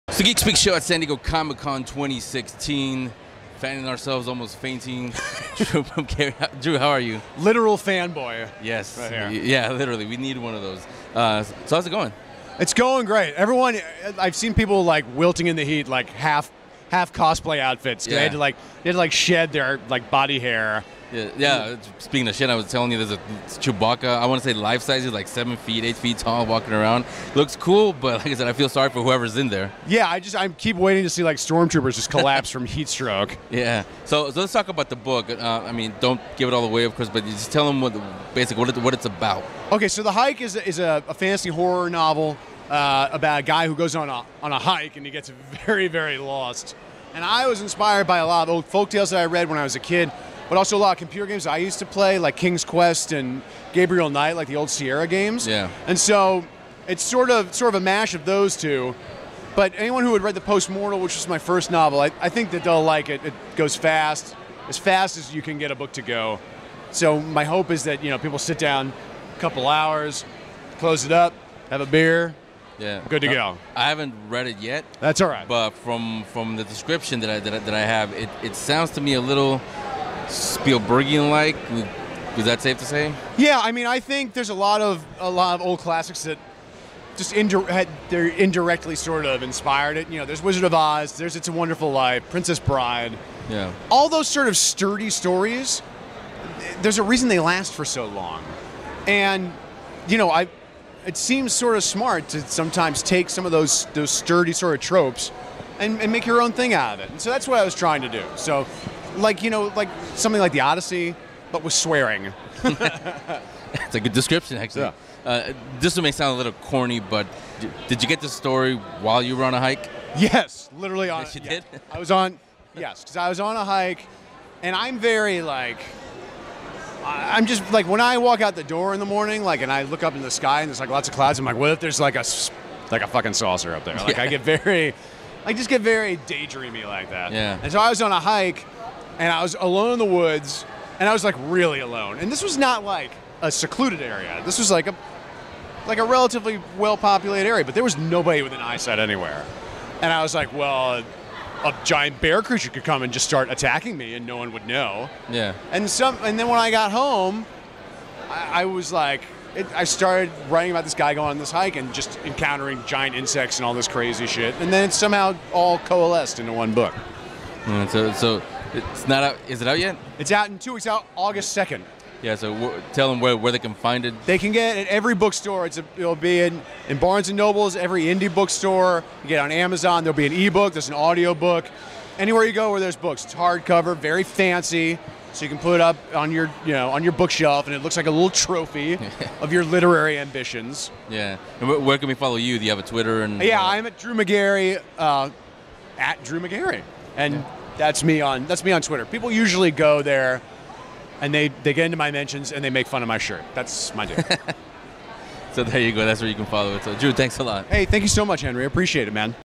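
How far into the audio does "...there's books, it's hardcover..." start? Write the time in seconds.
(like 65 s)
182 s.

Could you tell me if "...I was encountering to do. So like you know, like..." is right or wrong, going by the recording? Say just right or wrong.
wrong.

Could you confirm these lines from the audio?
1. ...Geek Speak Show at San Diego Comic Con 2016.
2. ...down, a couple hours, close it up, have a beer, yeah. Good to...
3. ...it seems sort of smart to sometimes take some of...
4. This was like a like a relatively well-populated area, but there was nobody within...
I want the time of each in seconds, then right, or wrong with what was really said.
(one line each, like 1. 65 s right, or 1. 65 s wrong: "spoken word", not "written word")
1. 0 s right
2. 68 s right
3. 101 s right
4. 144 s right.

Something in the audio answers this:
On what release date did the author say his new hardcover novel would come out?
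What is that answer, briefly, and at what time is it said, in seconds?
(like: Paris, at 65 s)
August 2, at 171 s.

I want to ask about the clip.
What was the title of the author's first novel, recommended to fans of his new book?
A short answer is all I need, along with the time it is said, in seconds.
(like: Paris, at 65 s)
The Postmortal, at 60 s.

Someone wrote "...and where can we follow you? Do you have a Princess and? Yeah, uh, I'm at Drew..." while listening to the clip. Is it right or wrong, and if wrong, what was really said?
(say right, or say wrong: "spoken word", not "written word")
wrong: "Twitter", not "Princess".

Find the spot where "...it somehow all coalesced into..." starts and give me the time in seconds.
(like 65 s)
164 s.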